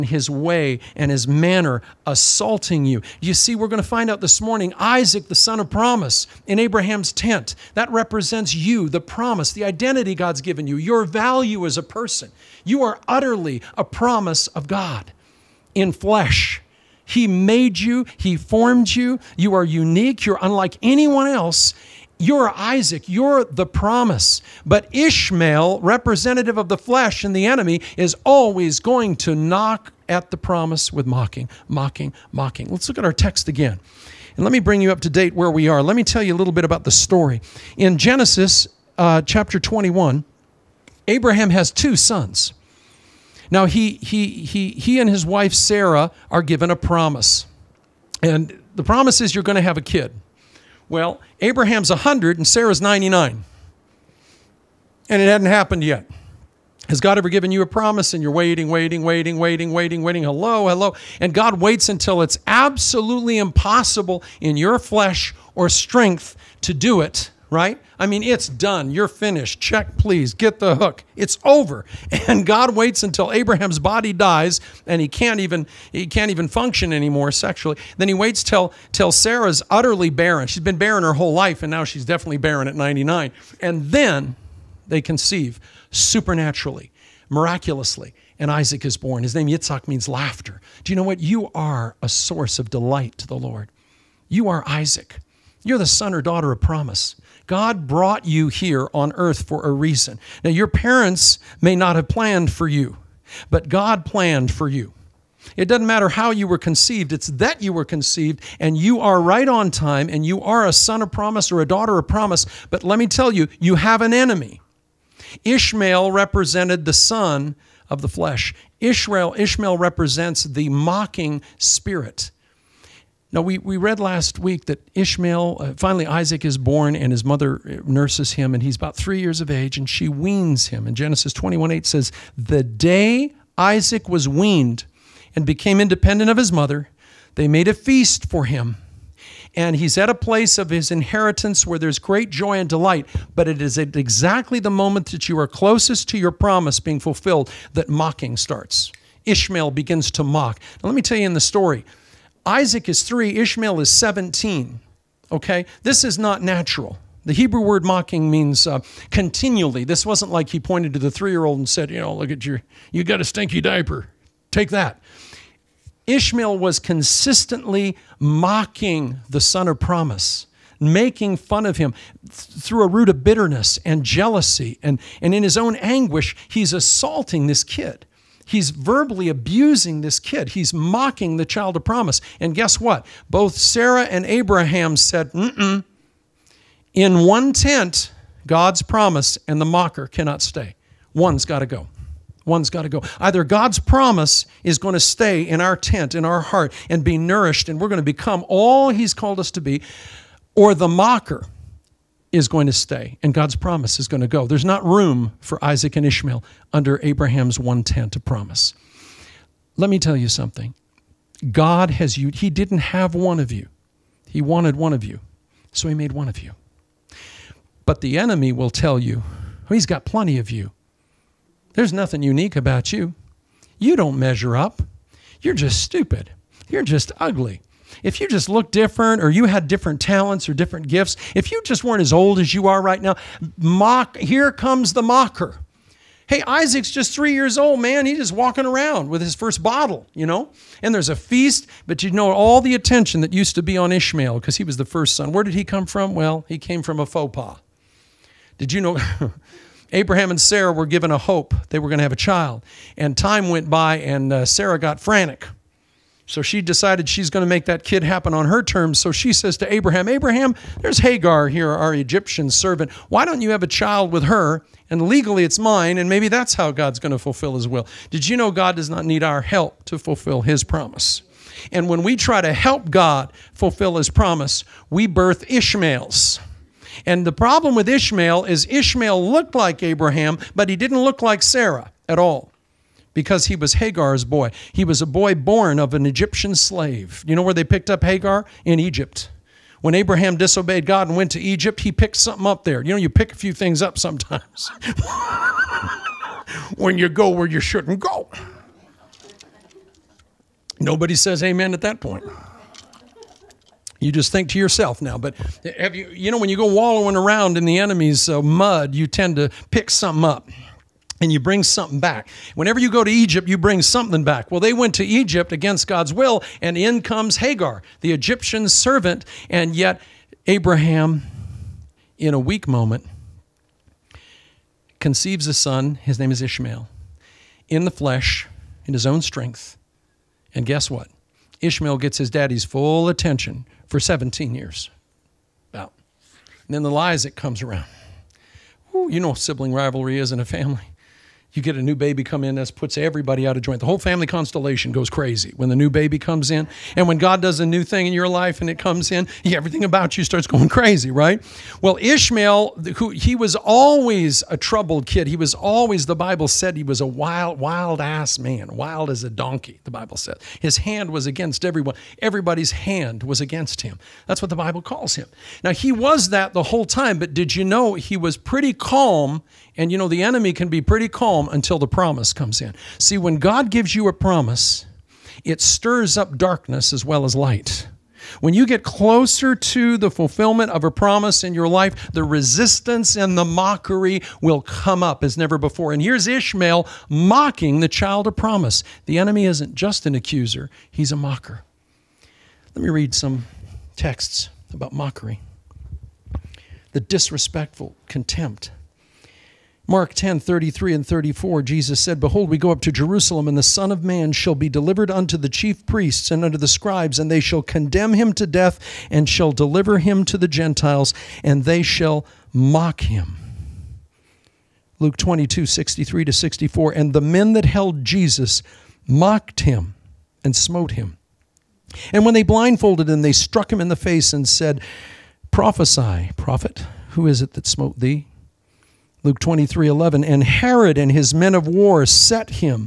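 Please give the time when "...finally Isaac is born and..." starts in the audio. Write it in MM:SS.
02:05.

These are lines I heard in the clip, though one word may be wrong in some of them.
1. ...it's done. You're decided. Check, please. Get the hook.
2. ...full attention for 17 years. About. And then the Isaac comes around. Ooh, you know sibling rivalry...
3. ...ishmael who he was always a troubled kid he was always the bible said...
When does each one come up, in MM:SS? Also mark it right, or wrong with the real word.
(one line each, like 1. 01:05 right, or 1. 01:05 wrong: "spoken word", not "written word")
1. 01:08 wrong: "finished", not "decided"
2. 05:32 right
3. 05:52 right.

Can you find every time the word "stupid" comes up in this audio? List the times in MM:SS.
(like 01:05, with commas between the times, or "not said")
03:45.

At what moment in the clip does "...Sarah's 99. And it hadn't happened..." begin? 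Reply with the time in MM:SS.
00:52.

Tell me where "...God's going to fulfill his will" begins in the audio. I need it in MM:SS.
04:26.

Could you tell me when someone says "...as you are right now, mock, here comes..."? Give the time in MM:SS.
03:52.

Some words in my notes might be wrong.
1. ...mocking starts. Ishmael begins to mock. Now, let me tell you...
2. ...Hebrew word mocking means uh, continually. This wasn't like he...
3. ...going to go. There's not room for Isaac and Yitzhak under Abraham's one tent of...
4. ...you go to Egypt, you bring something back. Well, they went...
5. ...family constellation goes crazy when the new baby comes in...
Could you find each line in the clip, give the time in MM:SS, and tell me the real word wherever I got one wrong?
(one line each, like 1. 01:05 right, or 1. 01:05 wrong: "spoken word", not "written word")
1. 02:27 right
2. 02:37 right
3. 03:24 wrong: "Ishmael", not "Yitzhak"
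4. 05:12 right
5. 05:43 right.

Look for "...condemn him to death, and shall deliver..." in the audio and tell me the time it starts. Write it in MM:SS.
06:47.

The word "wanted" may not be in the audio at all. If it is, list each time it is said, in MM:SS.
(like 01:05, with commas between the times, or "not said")
03:34.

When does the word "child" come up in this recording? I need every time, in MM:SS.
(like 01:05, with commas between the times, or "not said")
03:01, 04:12, 04:23, 06:27.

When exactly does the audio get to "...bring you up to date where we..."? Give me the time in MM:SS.
00:34.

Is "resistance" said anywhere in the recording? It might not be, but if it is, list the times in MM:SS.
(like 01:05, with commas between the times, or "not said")
06:22.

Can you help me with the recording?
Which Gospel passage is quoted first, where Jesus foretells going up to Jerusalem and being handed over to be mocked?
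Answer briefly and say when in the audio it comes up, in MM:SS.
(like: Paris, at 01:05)
Mark 10:33-34, at 06:39.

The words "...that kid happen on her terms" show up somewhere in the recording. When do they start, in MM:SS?
04:17.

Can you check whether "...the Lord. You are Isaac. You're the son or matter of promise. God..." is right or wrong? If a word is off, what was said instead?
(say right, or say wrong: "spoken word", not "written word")
wrong: "daughter", not "matter".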